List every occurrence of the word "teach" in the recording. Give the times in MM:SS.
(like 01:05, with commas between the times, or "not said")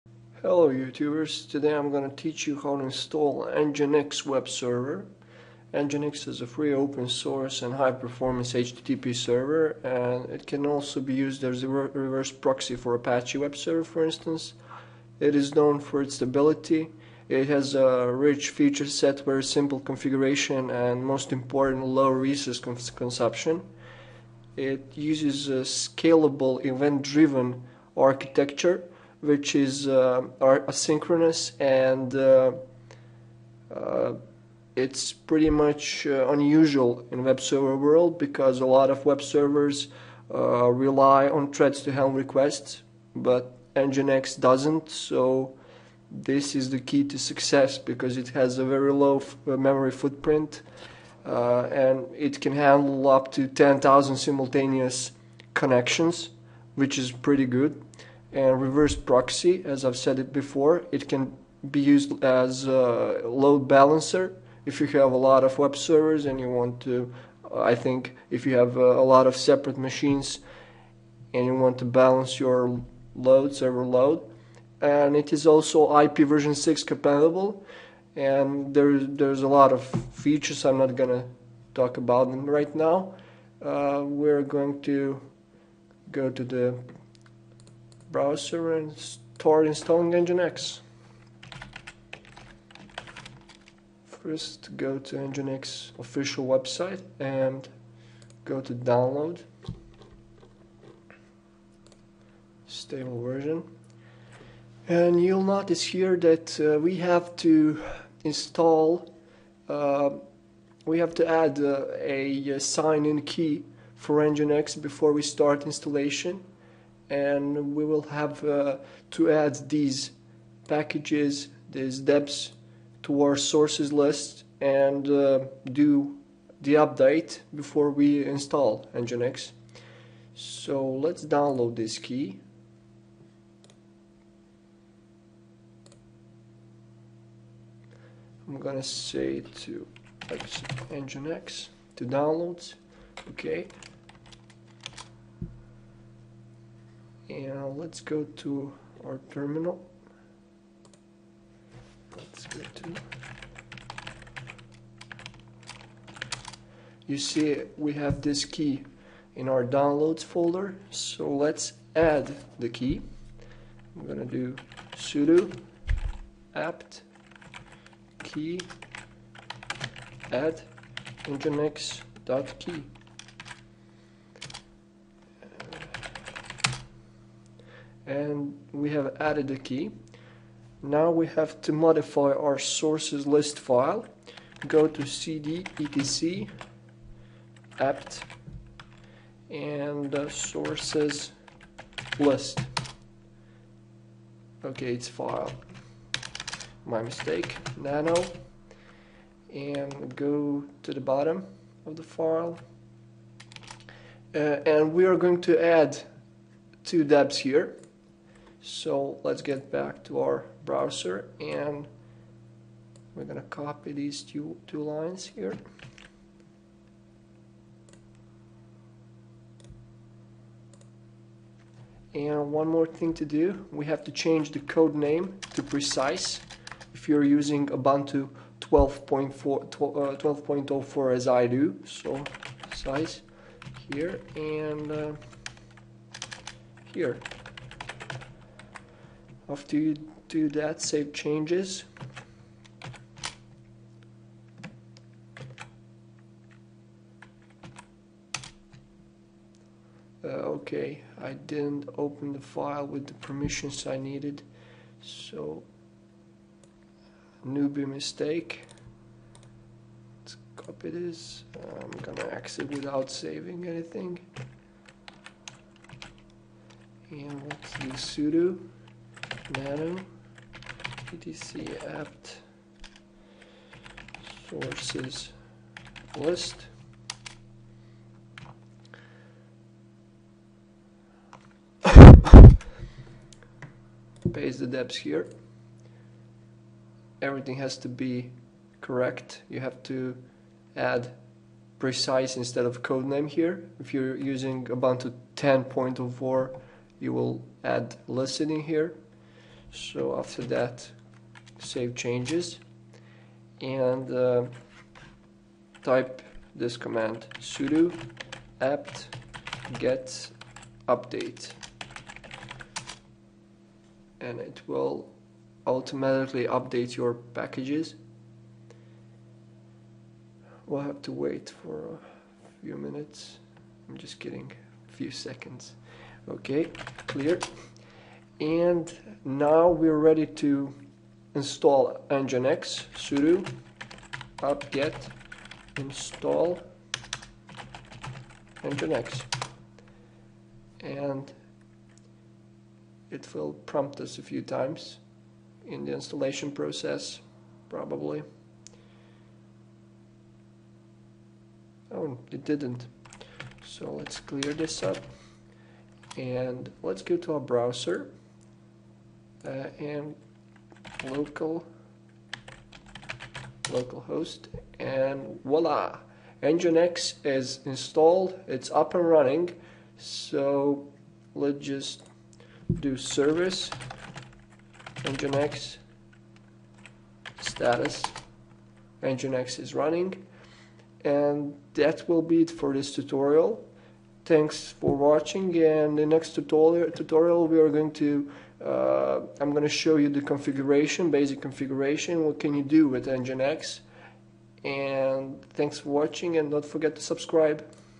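00:02.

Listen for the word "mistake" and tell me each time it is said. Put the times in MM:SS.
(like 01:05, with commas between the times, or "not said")
03:17, 04:17.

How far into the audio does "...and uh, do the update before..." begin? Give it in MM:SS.
02:04.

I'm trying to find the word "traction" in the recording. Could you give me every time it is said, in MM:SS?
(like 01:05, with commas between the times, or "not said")
not said.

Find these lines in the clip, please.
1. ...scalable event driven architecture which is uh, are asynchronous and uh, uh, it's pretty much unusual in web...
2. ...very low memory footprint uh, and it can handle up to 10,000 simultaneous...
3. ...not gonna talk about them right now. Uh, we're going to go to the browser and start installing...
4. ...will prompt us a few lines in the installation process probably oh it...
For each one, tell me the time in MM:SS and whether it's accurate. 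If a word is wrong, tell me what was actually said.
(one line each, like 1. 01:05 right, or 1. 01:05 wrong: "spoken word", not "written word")
1. 00:25 right
2. 00:48 right
3. 01:20 right
4. 05:43 wrong: "times", not "lines".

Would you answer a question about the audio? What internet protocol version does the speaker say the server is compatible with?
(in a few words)
IP version 6.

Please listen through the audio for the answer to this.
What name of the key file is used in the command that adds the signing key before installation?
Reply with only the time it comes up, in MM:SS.
02:51.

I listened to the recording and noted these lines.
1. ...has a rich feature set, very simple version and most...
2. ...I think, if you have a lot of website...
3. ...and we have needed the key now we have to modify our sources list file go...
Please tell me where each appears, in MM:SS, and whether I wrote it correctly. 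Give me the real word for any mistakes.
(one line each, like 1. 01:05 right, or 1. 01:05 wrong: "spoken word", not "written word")
1. 00:17 wrong: "configuration", not "version"
2. 01:07 wrong: "separate", not "website"
3. 02:58 wrong: "added", not "needed".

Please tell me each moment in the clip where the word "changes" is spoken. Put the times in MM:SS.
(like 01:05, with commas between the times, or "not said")
03:44, 04:01, 05:01.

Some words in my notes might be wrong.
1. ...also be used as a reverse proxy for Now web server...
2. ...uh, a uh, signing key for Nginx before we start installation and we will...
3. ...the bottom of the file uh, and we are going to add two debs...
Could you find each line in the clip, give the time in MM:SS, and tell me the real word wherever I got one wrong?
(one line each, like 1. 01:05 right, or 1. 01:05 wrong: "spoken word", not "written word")
1. 00:10 wrong: "Apache", not "Now"
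2. 01:51 right
3. 03:20 right.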